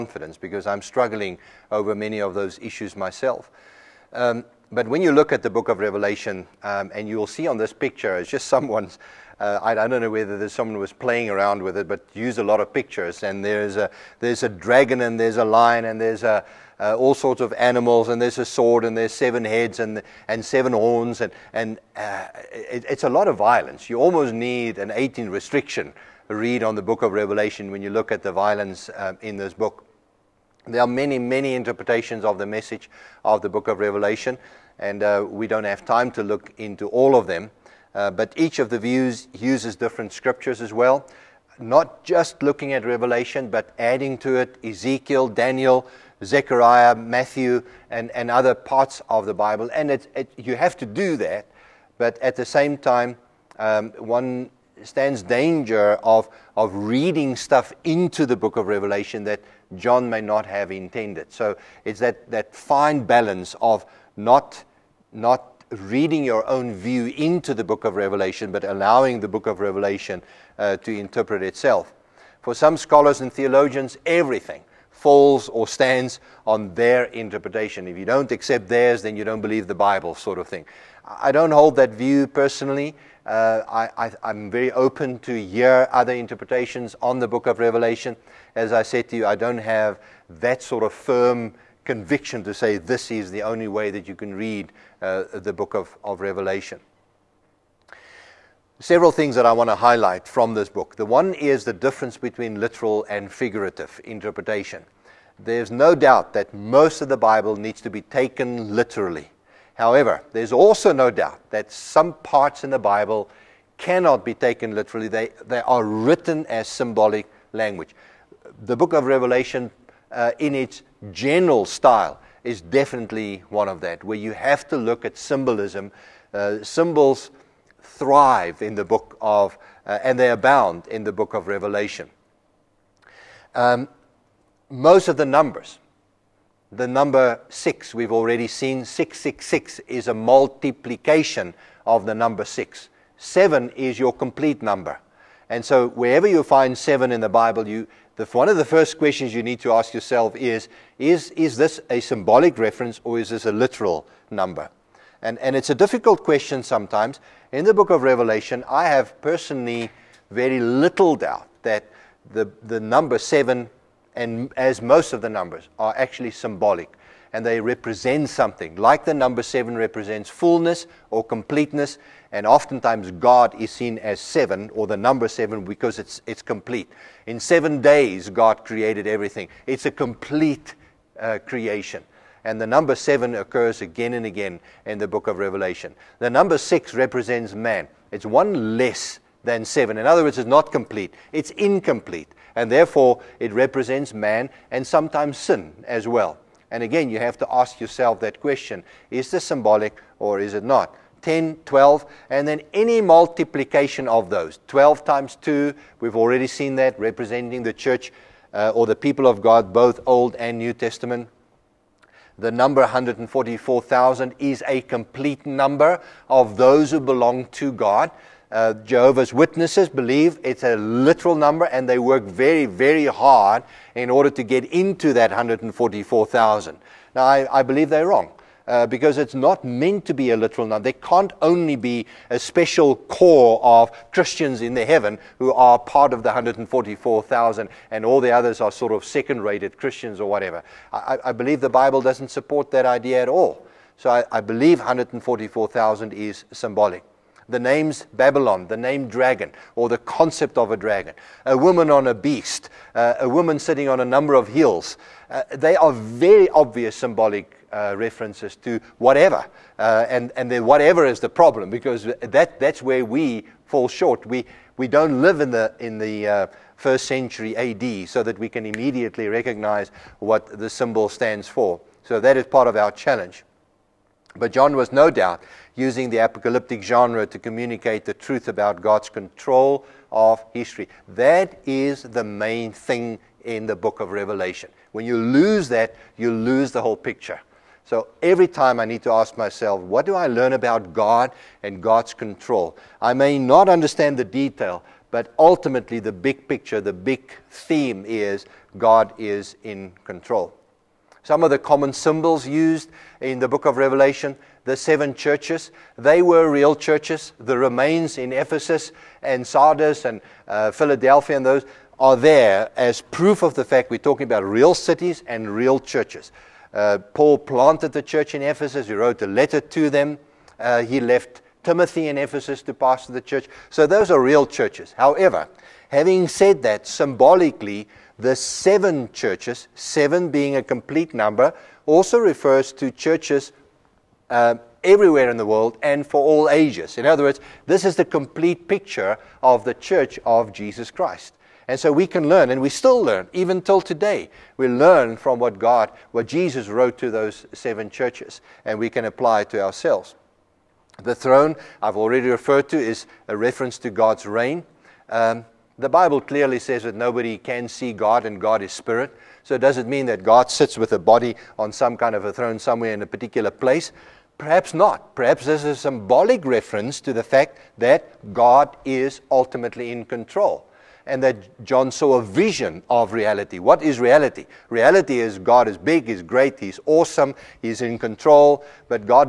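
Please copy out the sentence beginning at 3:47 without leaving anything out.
Now, I, I, believe they're wrong.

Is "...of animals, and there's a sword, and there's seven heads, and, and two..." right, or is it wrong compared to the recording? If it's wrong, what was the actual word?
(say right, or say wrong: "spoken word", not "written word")
wrong: "seven", not "two".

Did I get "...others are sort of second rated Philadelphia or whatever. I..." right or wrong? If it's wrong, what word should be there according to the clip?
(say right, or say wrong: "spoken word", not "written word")
wrong: "Christians", not "Philadelphia".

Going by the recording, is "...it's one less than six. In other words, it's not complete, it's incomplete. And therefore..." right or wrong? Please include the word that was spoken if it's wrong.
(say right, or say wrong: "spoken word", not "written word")
wrong: "seven", not "six".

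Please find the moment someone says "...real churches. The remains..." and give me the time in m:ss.
5:06.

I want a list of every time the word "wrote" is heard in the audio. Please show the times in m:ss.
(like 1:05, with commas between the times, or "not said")
5:18, 5:46.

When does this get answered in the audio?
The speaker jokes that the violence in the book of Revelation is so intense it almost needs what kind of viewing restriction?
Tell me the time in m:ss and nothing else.
0:24.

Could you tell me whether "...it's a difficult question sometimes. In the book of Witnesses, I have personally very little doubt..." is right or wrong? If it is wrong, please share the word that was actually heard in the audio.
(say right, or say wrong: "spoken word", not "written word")
wrong: "Revelation", not "Witnesses".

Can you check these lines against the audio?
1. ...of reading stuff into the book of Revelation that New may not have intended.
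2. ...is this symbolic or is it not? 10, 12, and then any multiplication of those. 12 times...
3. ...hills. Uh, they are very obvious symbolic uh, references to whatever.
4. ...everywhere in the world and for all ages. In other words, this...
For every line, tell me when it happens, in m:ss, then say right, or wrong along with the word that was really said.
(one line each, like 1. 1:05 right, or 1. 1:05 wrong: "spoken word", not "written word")
1. 0:56 wrong: "John", not "New"
2. 3:19 right
3. 4:14 right
4. 5:34 right.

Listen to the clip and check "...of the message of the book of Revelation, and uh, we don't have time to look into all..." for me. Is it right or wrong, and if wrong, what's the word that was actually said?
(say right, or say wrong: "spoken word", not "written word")
right.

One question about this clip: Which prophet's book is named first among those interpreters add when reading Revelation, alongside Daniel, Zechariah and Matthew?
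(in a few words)
Ezekiel.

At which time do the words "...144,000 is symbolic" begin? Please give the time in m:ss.
4:04.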